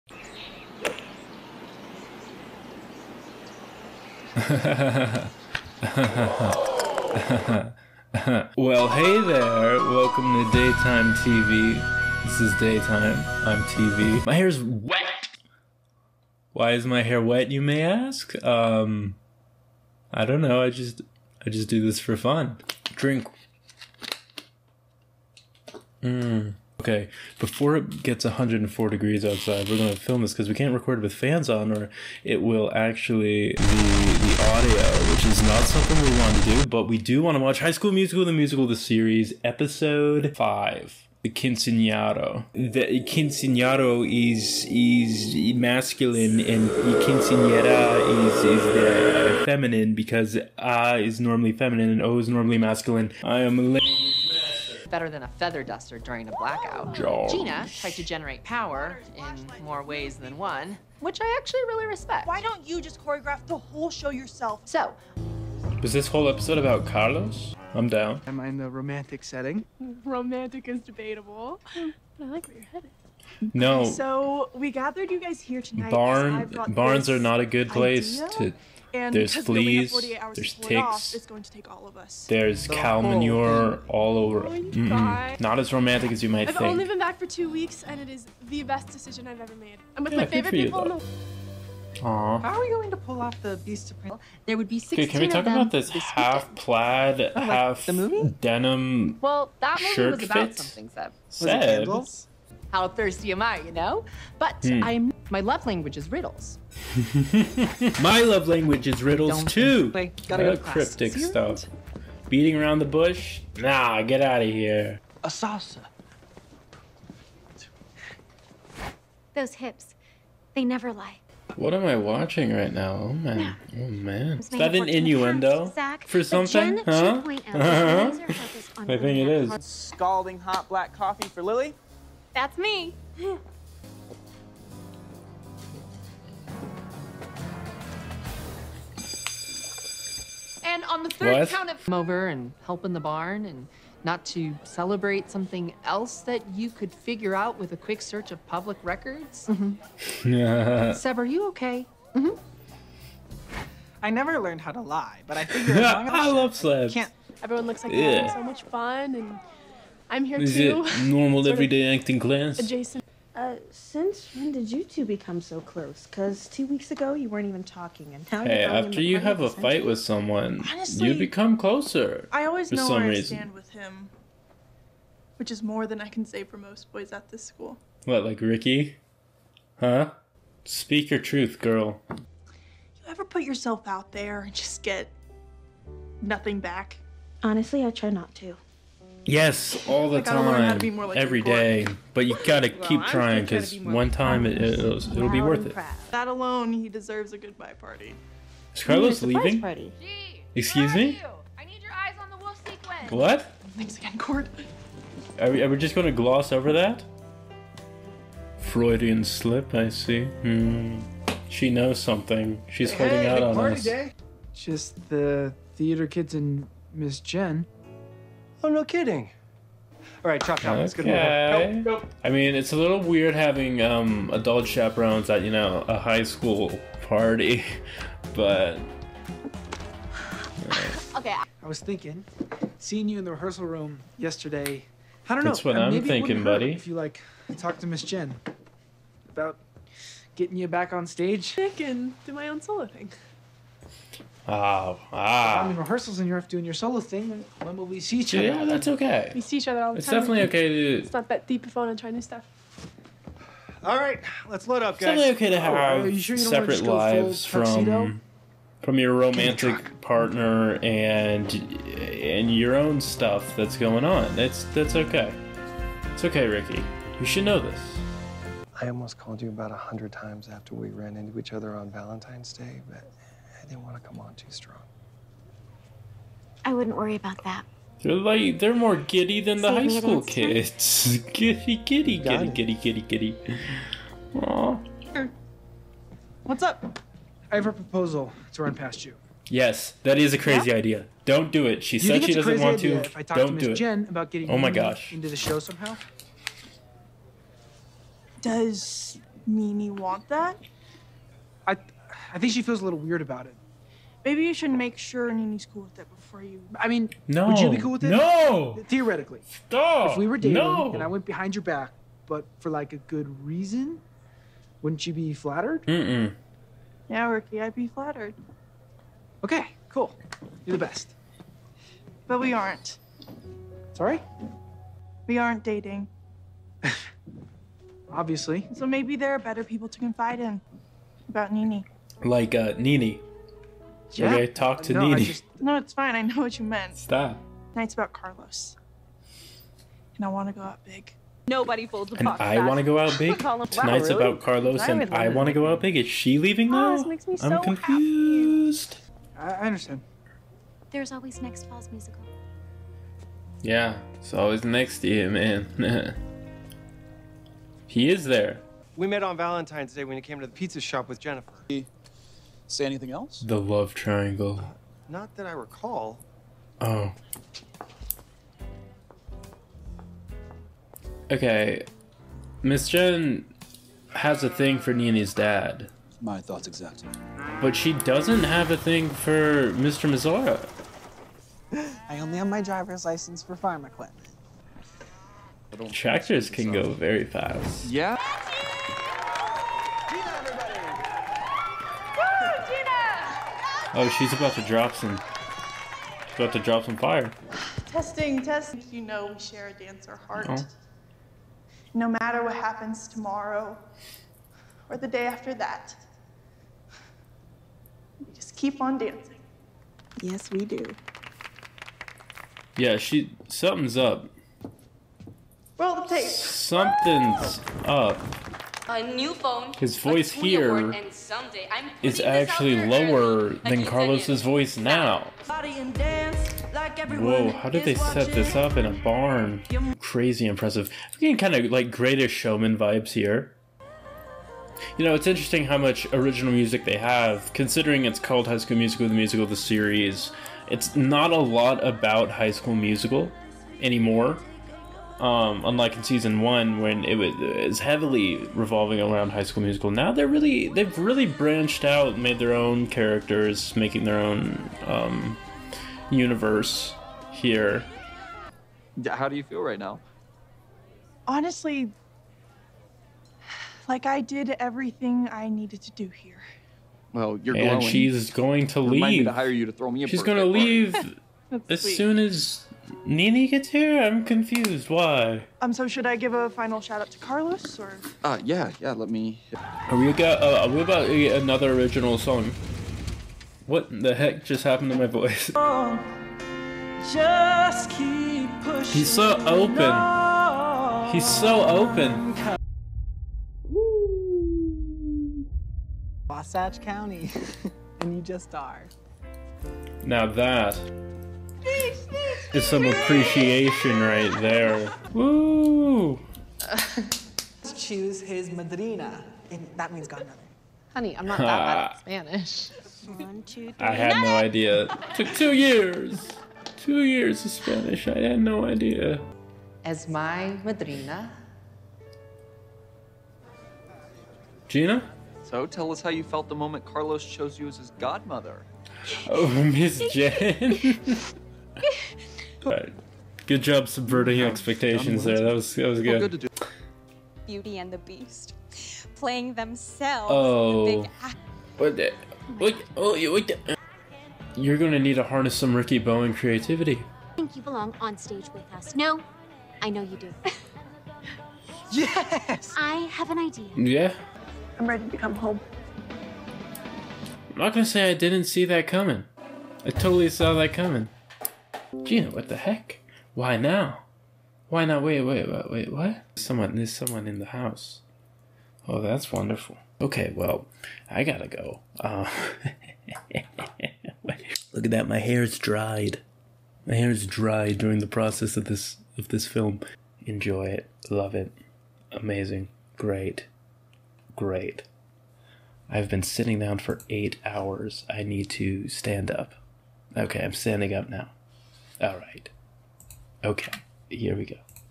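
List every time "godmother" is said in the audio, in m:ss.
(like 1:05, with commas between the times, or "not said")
8:30, 8:47.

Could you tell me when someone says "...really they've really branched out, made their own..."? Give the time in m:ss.
7:30.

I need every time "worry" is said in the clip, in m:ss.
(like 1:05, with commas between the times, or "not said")
4:36.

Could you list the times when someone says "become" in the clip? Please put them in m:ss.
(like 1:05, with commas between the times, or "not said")
2:45, 2:51.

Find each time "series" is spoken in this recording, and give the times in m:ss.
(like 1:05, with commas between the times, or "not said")
0:38, 7:19.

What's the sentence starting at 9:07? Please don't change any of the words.
I think you belong on stage with us.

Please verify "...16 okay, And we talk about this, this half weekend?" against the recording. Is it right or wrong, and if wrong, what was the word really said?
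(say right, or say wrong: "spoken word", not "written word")
wrong: "Can", not "And".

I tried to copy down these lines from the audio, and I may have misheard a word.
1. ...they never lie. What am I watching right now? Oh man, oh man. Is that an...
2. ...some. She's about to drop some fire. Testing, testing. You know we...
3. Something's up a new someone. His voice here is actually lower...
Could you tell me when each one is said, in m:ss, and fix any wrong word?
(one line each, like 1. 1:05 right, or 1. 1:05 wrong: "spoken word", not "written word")
1. 2:00 right
2. 6:34 right
3. 6:56 wrong: "phone", not "someone".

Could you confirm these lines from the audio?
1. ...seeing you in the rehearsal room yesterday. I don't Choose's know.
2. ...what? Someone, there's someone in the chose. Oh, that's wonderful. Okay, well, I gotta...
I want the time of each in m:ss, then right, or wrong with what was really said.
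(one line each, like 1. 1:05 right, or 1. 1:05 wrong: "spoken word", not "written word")
1. 3:52 wrong: "That", not "Choose"
2. 9:25 wrong: "house", not "chose".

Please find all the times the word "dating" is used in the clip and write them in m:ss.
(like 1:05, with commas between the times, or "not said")
5:10, 5:25.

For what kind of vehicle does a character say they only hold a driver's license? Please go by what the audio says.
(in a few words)
Farm equipment.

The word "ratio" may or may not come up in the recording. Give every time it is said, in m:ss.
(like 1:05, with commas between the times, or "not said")
not said.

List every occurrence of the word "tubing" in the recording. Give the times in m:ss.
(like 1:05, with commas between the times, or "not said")
not said.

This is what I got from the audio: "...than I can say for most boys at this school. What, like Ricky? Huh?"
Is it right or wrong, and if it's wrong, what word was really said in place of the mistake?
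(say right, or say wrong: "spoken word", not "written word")
right.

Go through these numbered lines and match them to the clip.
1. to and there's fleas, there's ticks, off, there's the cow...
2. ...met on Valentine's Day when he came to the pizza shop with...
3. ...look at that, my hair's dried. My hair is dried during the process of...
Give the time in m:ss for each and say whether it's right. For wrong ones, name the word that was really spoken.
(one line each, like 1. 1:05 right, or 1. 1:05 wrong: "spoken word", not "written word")
1. 1:18 right
2. 5:59 right
3. 9:34 right.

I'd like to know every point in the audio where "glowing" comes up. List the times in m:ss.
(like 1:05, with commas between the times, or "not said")
7:47.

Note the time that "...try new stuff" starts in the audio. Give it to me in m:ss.
4:12.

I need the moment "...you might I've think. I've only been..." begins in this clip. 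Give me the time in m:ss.
1:26.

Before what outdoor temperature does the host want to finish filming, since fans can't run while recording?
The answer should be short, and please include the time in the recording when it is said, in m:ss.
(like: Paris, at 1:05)
104 degrees, at 0:28.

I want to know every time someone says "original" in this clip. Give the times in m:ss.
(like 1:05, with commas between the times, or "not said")
7:16, 8:01.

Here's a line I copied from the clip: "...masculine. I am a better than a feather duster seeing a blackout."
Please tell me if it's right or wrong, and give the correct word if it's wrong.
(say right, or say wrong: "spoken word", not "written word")
wrong: "during", not "seeing".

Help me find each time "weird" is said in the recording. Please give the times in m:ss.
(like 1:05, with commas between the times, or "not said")
3:43, 5:02.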